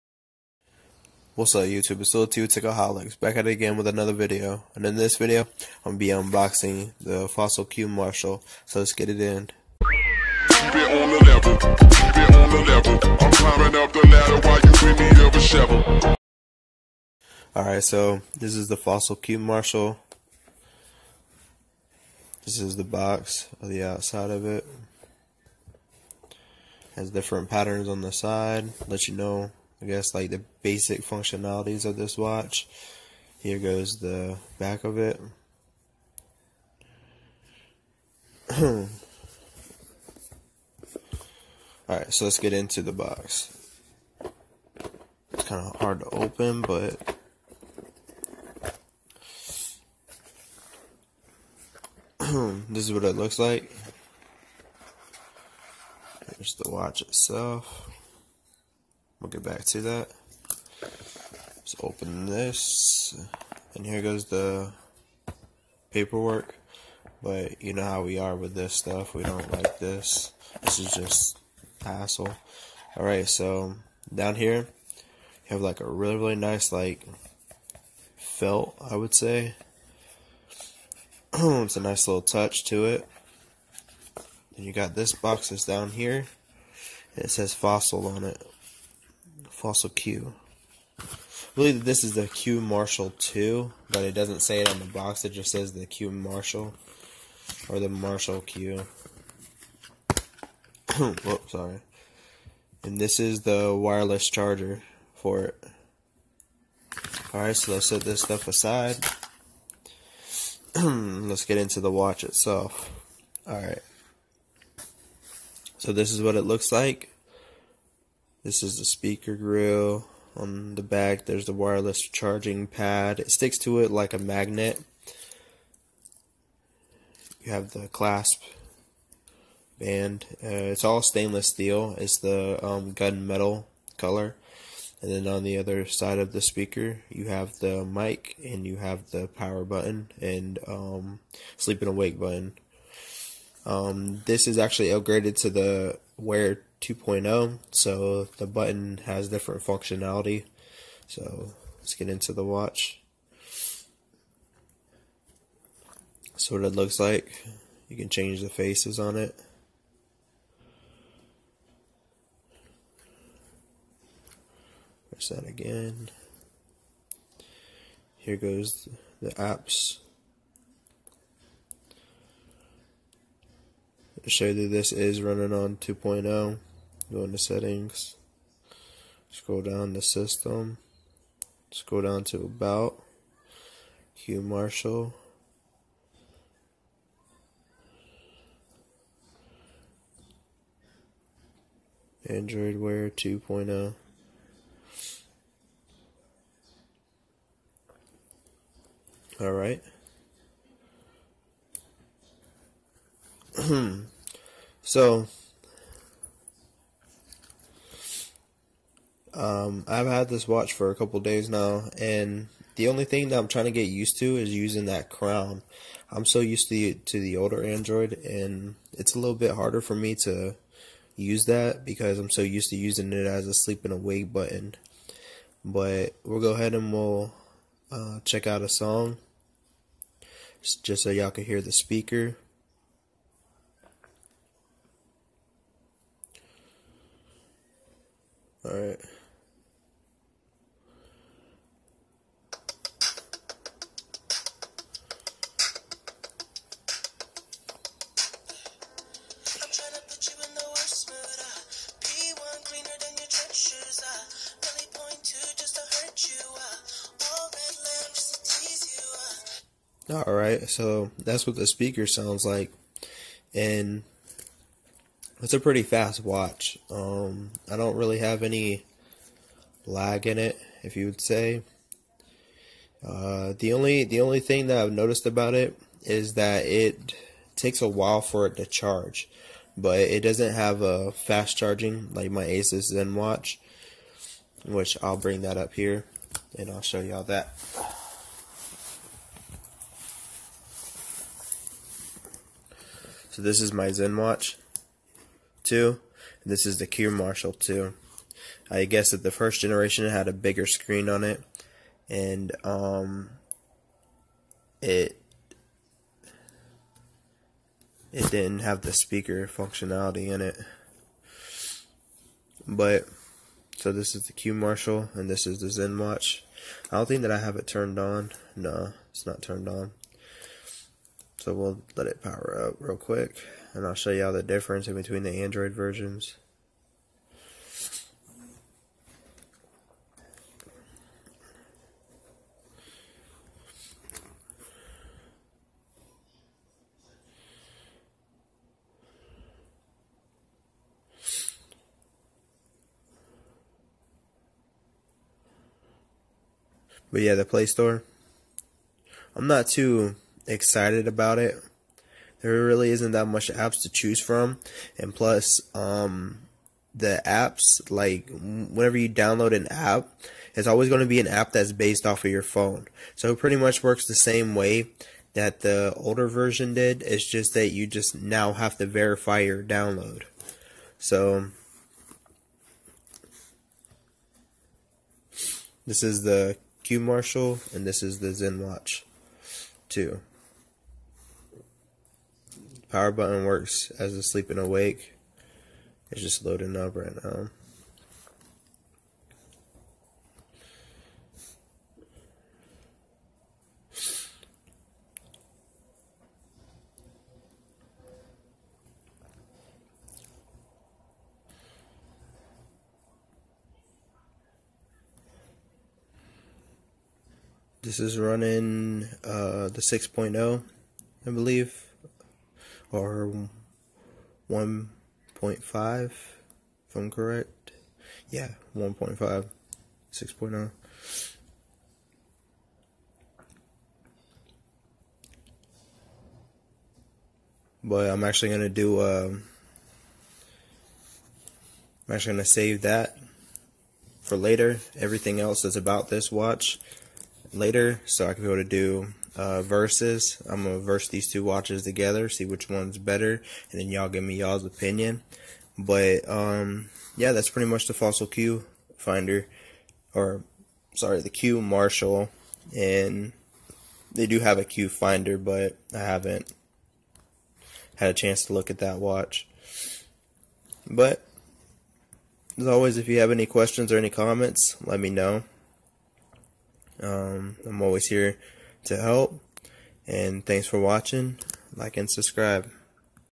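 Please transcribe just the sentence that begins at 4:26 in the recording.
Um, I don't really have any lag in it, if you would say.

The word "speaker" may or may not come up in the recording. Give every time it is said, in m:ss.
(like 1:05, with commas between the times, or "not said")
1:58, 2:16, 3:51, 4:21, 5:08.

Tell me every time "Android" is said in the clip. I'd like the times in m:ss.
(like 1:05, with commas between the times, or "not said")
3:12, 3:37, 5:25.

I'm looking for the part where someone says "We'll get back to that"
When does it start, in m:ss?
0:59.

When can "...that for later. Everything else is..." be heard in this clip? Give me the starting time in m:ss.
7:12.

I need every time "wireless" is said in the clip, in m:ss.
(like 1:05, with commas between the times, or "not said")
1:43, 2:01.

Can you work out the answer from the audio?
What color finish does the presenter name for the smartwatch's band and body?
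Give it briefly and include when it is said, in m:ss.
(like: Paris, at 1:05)
gunmetal, at 2:12.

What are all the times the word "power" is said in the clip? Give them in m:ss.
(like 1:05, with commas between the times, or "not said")
2:19, 5:22, 6:22.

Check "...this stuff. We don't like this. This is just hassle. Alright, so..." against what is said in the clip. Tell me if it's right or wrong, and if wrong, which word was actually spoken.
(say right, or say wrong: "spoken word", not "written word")
right.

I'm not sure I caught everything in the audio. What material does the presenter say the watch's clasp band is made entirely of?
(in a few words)
stainless steel.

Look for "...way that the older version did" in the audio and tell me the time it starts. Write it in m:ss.
6:04.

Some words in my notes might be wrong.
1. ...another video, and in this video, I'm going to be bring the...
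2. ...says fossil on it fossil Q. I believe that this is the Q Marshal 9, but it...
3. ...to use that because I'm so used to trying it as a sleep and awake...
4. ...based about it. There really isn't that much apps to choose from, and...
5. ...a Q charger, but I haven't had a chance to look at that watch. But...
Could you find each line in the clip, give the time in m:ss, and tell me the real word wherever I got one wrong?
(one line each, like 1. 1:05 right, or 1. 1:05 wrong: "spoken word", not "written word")
1. 0:03 wrong: "unboxing", not "bring"
2. 1:27 wrong: "2", not "9"
3. 3:40 wrong: "using", not "trying"
4. 5:50 wrong: "excited", not "based"
5. 7:34 wrong: "finder", not "charger".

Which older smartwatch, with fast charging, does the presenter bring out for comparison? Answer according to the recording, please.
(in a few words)
Asus ZenWatch.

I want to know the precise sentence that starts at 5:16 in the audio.
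I don't think that I have it turned on.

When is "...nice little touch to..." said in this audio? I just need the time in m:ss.
1:21.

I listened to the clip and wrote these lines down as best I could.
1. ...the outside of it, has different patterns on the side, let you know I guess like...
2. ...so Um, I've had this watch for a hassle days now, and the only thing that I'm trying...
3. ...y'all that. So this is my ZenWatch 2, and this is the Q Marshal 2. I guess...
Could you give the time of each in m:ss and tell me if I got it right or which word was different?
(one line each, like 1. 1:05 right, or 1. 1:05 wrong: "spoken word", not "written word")
1. 0:23 right
2. 3:24 wrong: "couple", not "hassle"
3. 4:46 right.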